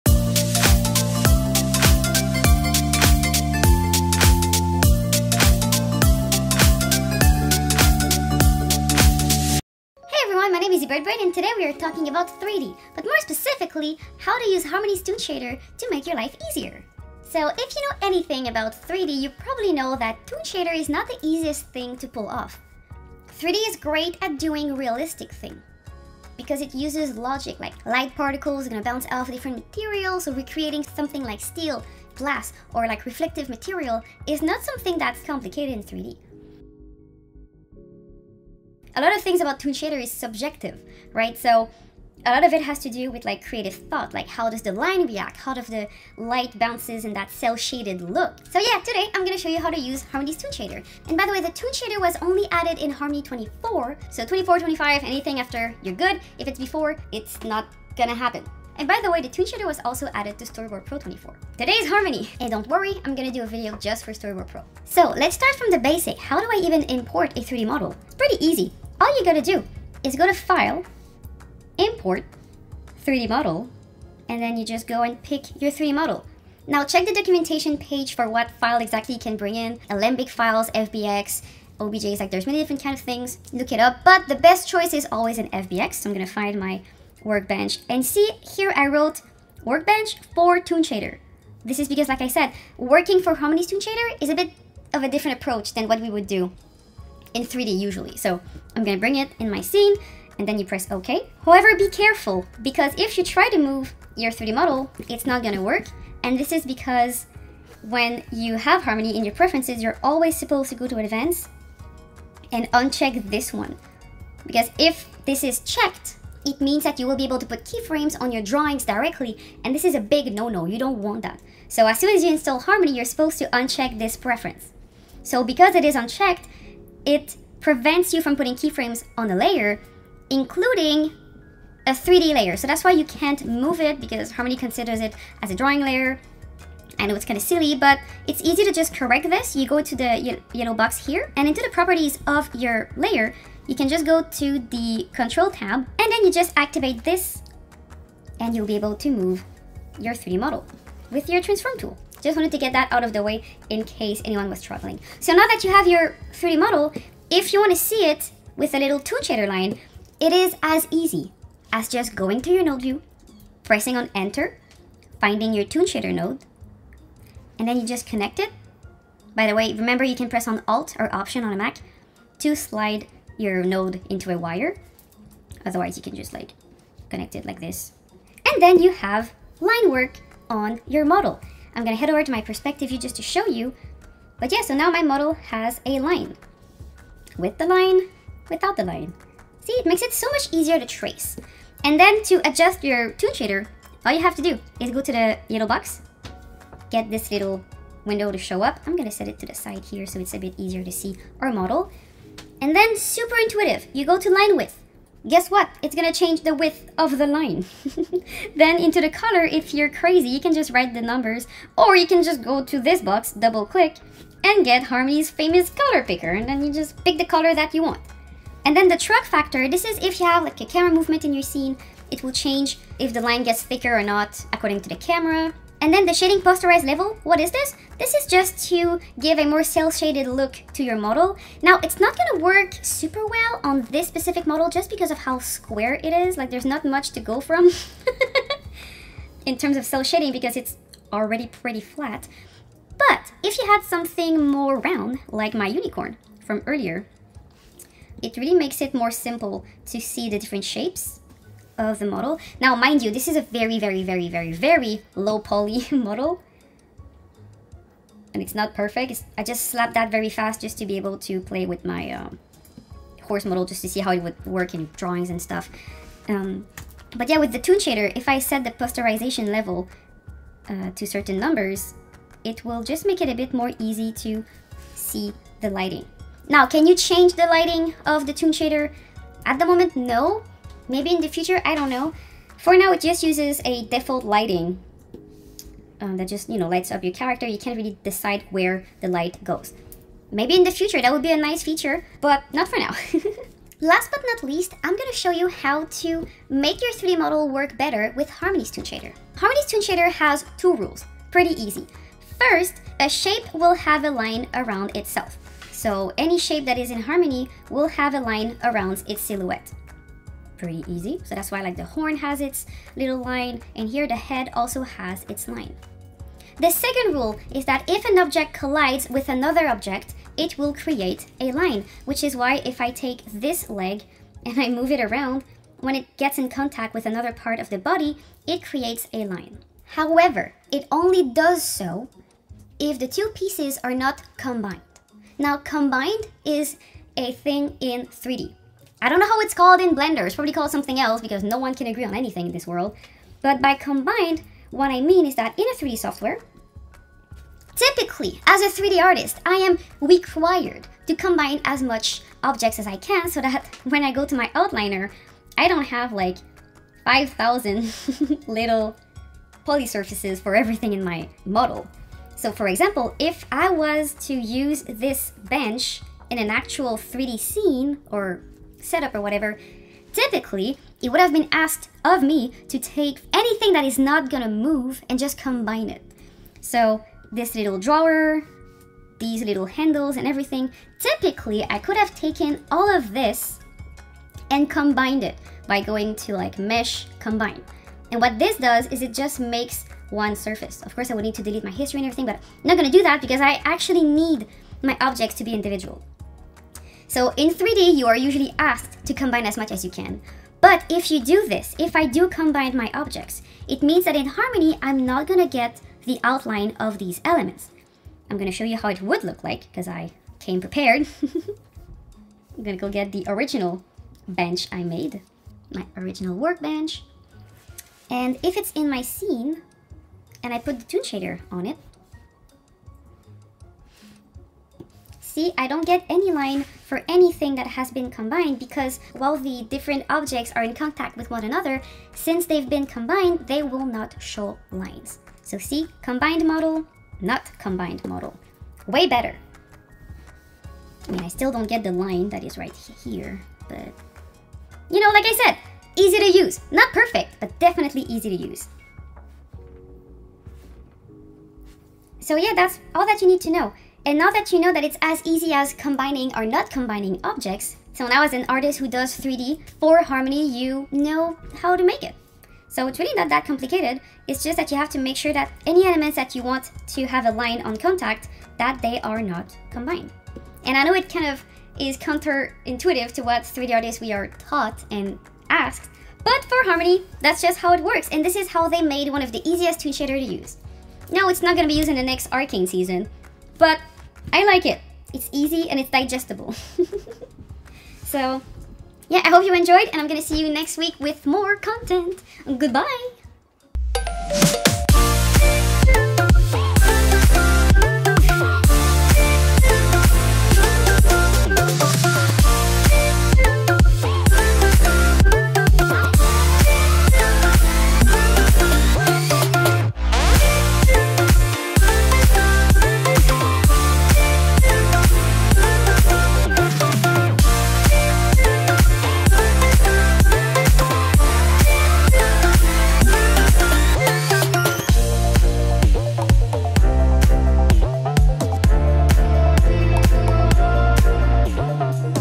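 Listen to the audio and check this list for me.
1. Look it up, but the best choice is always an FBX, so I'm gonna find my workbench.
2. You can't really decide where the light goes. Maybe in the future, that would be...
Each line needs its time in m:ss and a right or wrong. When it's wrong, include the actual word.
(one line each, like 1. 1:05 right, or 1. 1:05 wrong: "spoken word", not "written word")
1. 1:23 right
2. 4:47 right.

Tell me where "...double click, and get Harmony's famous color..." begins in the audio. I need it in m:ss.
3:33.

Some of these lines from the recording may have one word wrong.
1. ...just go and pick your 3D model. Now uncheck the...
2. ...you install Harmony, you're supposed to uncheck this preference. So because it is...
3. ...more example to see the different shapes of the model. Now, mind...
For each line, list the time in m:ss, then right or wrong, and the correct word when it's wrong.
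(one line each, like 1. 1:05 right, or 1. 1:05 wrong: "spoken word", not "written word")
1. 1:14 wrong: "check", not "uncheck"
2. 2:02 right
3. 4:08 wrong: "simple", not "example".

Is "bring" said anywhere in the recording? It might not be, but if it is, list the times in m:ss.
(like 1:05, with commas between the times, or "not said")
1:19, 1:38.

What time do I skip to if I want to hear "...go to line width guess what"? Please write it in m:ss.
3:24.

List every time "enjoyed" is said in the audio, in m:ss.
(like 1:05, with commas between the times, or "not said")
8:09.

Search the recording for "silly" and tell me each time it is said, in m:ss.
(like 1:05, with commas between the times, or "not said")
2:17.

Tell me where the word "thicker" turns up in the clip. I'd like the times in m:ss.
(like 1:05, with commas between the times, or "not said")
3:43.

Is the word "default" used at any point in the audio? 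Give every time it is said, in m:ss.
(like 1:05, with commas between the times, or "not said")
4:43.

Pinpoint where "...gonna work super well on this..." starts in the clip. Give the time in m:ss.
3:52.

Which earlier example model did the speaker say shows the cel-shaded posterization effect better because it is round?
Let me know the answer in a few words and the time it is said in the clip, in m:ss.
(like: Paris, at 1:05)
unicorn, at 4:05.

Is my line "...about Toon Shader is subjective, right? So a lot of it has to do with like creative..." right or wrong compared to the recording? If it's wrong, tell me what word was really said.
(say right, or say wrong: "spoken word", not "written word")
right.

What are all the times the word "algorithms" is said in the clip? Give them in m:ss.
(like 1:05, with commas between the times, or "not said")
not said.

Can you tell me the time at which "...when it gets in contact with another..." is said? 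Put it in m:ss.
5:25.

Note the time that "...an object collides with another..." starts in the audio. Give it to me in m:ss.
5:18.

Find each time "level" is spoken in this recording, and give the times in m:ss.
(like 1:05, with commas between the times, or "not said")
3:46, 4:29.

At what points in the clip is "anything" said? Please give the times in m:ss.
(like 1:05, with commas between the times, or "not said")
0:18, 0:55, 5:42, 6:13, 7:07.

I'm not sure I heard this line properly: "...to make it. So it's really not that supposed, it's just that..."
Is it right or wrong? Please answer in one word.
wrong.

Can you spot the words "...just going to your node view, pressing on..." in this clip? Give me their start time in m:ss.
2:41.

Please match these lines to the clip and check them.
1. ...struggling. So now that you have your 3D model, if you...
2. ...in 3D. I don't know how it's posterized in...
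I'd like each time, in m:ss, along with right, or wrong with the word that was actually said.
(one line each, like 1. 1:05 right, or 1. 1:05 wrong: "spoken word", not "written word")
1. 2:34 right
2. 5:37 wrong: "called", not "posterized".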